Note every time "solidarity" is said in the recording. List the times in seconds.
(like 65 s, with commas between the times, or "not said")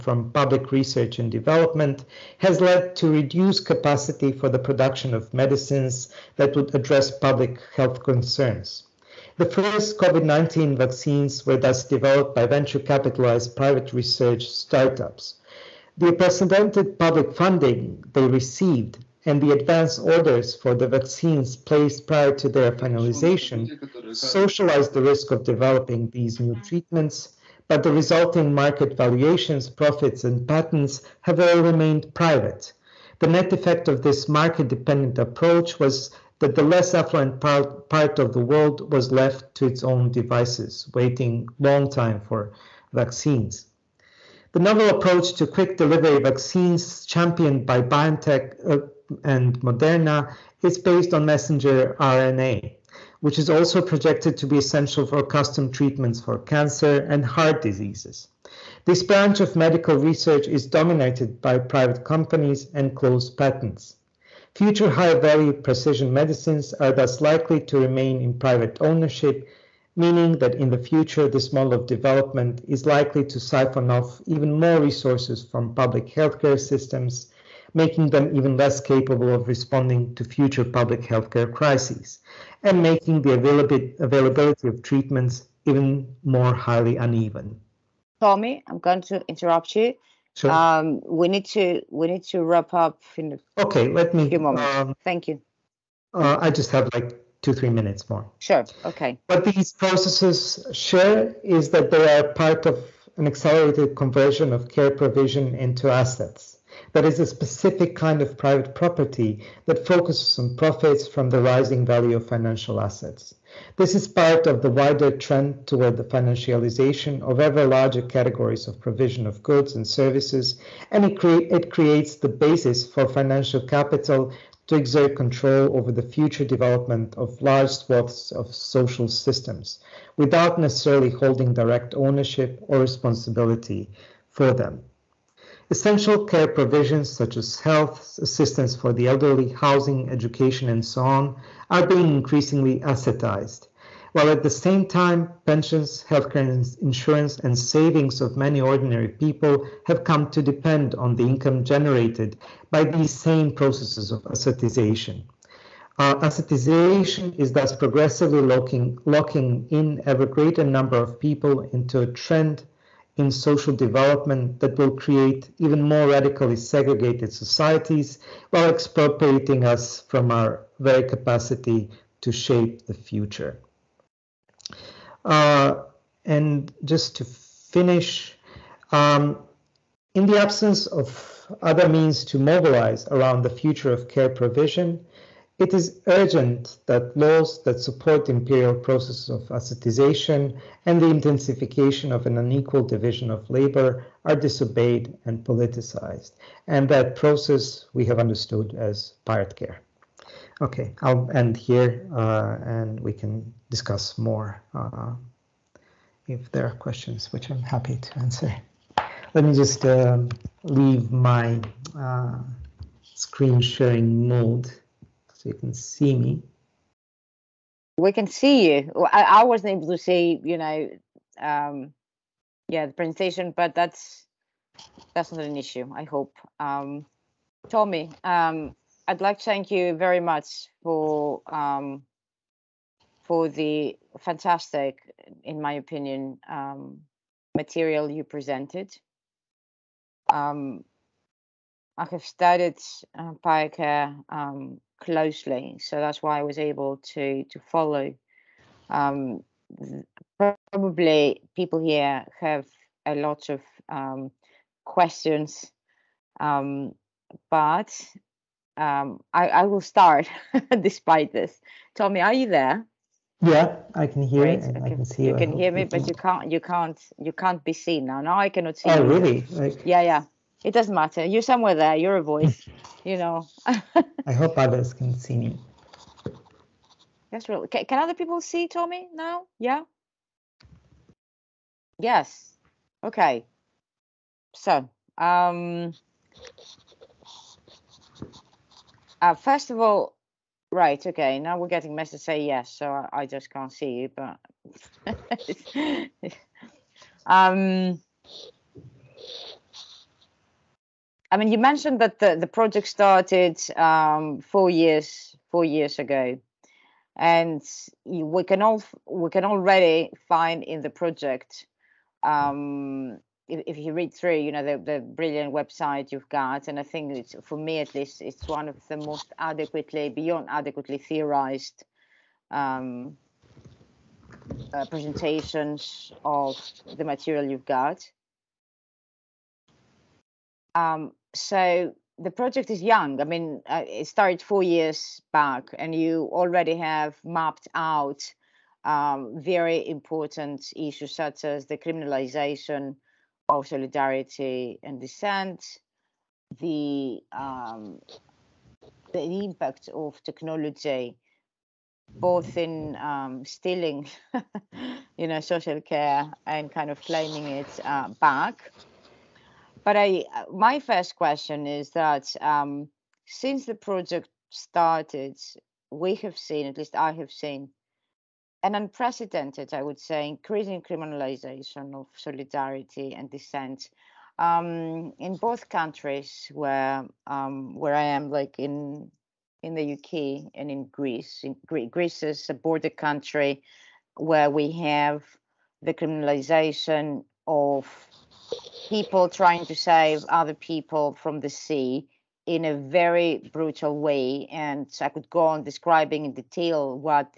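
343 s, 372 s.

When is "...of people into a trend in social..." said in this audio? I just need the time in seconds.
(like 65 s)
160 s.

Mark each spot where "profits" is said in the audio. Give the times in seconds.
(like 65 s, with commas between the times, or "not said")
29 s, 110 s.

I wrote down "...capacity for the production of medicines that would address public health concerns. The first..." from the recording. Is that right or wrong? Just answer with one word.
right.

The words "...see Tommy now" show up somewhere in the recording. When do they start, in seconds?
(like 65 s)
278 s.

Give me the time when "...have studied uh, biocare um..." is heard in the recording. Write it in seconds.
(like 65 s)
242 s.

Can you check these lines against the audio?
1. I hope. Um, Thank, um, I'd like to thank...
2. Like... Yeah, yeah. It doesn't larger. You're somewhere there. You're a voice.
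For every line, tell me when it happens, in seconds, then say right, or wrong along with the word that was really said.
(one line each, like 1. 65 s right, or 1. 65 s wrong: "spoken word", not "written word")
1. 225 s wrong: "Tommy", not "Thank"
2. 269 s wrong: "matter", not "larger".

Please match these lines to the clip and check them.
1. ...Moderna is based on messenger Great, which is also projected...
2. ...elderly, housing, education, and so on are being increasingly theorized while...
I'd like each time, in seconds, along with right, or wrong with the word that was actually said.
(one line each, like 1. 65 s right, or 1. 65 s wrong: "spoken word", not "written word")
1. 49 s wrong: "RNA", not "Great"
2. 139 s wrong: "assetized", not "theorized".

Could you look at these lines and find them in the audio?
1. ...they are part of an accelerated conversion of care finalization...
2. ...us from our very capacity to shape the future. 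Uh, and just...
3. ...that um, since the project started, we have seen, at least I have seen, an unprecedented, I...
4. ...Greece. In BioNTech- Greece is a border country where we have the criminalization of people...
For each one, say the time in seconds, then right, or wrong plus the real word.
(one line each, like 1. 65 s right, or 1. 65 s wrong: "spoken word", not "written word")
1. 101 s wrong: "provision", not "finalization"
2. 169 s right
3. 361 s right
4. 380 s wrong: "Gre", not "BioNTech".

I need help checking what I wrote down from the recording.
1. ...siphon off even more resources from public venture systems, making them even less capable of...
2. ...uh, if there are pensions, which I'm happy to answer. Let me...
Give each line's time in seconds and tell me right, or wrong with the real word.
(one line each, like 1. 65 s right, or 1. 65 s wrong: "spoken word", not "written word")
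1. 73 s wrong: "healthcare", not "venture"
2. 204 s wrong: "questions", not "pensions".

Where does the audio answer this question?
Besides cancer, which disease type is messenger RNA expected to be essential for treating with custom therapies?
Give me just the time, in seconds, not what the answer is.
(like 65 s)
57 s.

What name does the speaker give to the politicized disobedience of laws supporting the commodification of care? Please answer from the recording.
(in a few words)
pirate care.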